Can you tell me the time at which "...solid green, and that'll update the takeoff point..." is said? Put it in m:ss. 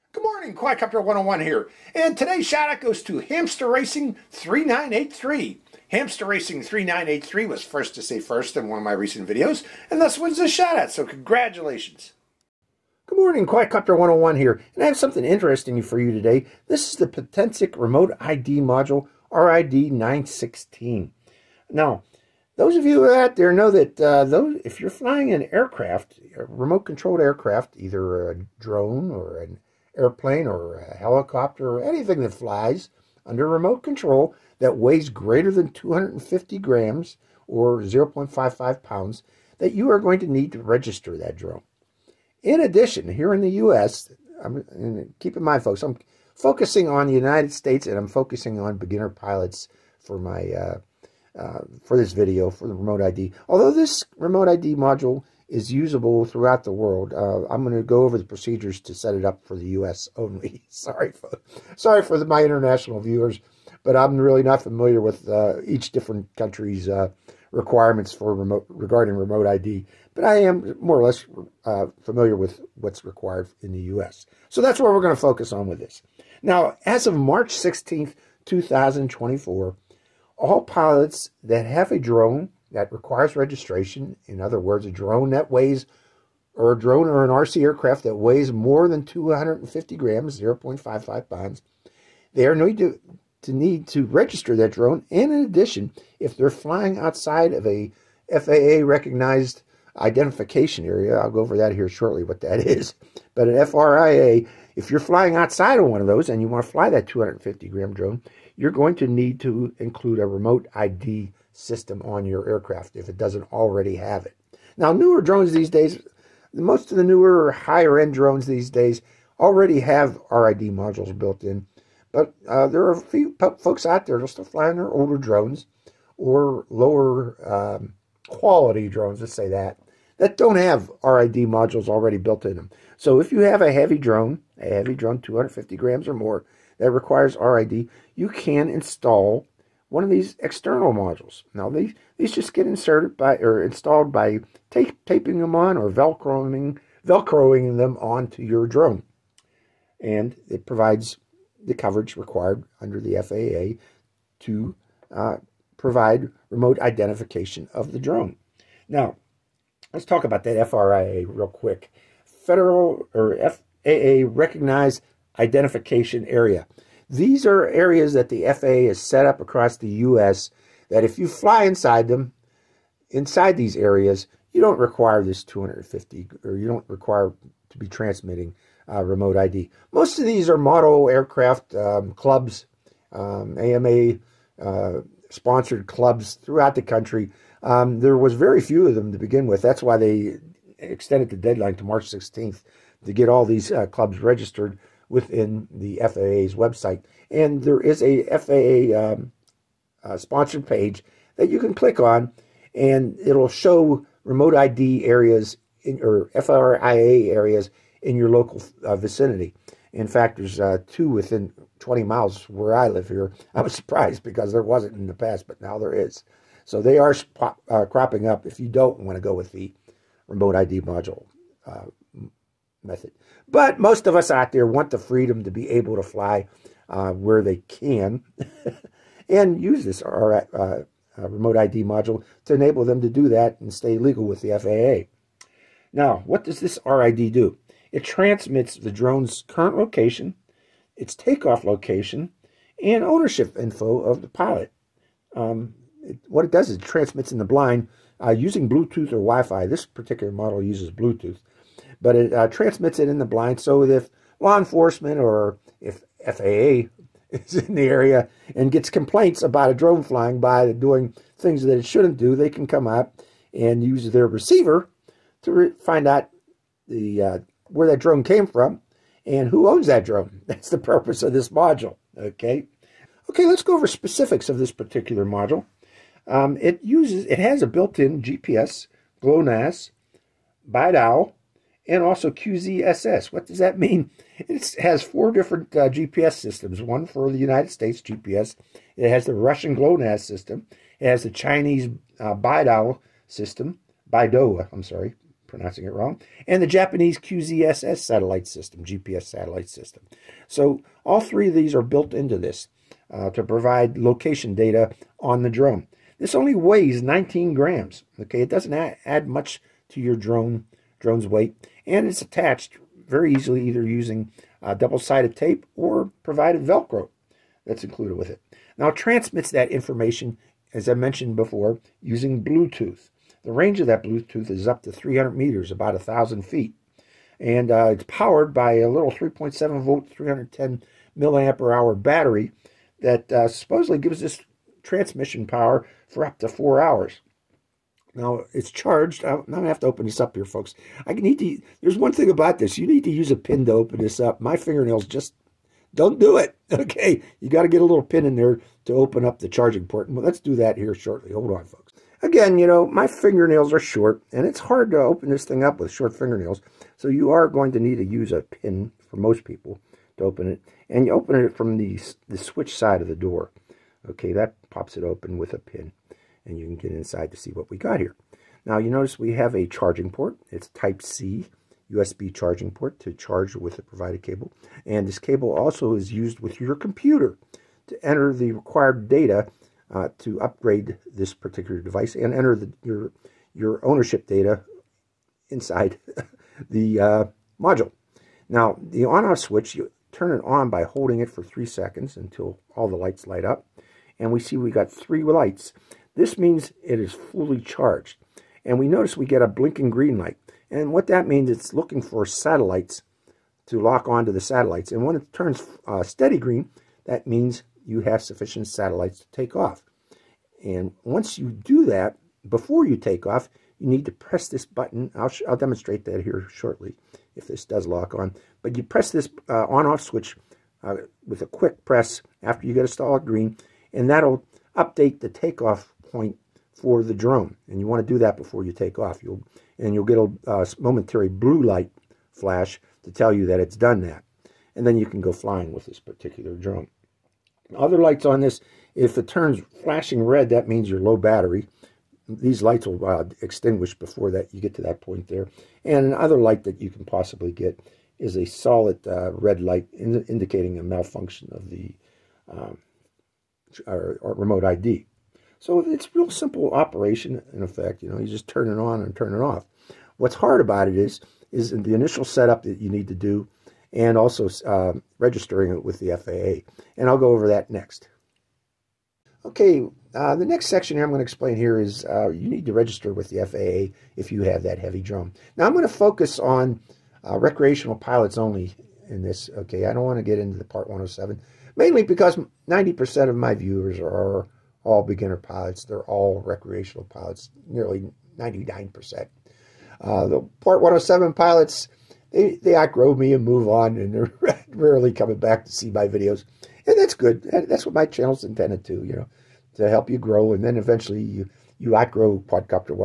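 7:02.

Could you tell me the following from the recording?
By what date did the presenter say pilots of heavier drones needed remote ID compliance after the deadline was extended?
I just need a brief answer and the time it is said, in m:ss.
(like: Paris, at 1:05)
March 16th, 2024, at 1:17.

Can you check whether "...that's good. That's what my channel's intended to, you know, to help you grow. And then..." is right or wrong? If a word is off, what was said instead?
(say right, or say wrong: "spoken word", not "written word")
right.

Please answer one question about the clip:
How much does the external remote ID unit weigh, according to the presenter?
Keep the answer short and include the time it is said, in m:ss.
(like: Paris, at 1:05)
19 grams, at 5:07.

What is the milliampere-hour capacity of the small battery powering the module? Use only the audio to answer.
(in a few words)
310.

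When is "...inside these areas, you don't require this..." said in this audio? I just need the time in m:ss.
2:53.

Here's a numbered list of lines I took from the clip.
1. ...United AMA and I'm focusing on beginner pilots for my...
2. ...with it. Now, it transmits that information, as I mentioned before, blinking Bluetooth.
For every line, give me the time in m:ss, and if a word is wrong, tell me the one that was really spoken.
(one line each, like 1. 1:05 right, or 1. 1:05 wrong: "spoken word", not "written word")
1. 0:47 wrong: "States", not "AMA"
2. 5:18 wrong: "using", not "blinking".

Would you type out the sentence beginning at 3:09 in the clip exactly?
That's why they extended the deadline to March 16th to get all these uh, clubs registered within the FAA's website.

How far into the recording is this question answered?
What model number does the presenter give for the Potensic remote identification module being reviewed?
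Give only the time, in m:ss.
0:19.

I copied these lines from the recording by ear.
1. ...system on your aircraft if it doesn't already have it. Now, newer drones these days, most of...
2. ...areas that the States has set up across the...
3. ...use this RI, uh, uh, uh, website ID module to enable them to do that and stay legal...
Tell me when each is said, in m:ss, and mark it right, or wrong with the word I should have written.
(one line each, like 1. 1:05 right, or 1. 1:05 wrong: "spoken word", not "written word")
1. 1:51 right
2. 2:47 wrong: "FAA", not "States"
3. 3:49 wrong: "remote", not "website".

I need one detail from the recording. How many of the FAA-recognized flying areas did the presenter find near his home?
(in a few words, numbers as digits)
2.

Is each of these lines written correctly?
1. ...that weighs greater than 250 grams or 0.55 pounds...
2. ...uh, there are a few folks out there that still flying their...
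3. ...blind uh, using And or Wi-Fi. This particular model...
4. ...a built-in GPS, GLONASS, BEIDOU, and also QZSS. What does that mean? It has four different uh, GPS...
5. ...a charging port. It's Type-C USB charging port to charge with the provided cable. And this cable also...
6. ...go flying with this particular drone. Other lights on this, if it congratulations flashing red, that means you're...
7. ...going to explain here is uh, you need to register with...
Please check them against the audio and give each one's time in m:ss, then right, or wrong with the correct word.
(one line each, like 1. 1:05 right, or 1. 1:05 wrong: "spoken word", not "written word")
1. 0:34 right
2. 2:02 right
3. 4:07 wrong: "Bluetooth", not "And"
4. 4:37 right
5. 6:09 right
6. 7:15 wrong: "turns", not "congratulations"
7. 7:51 right.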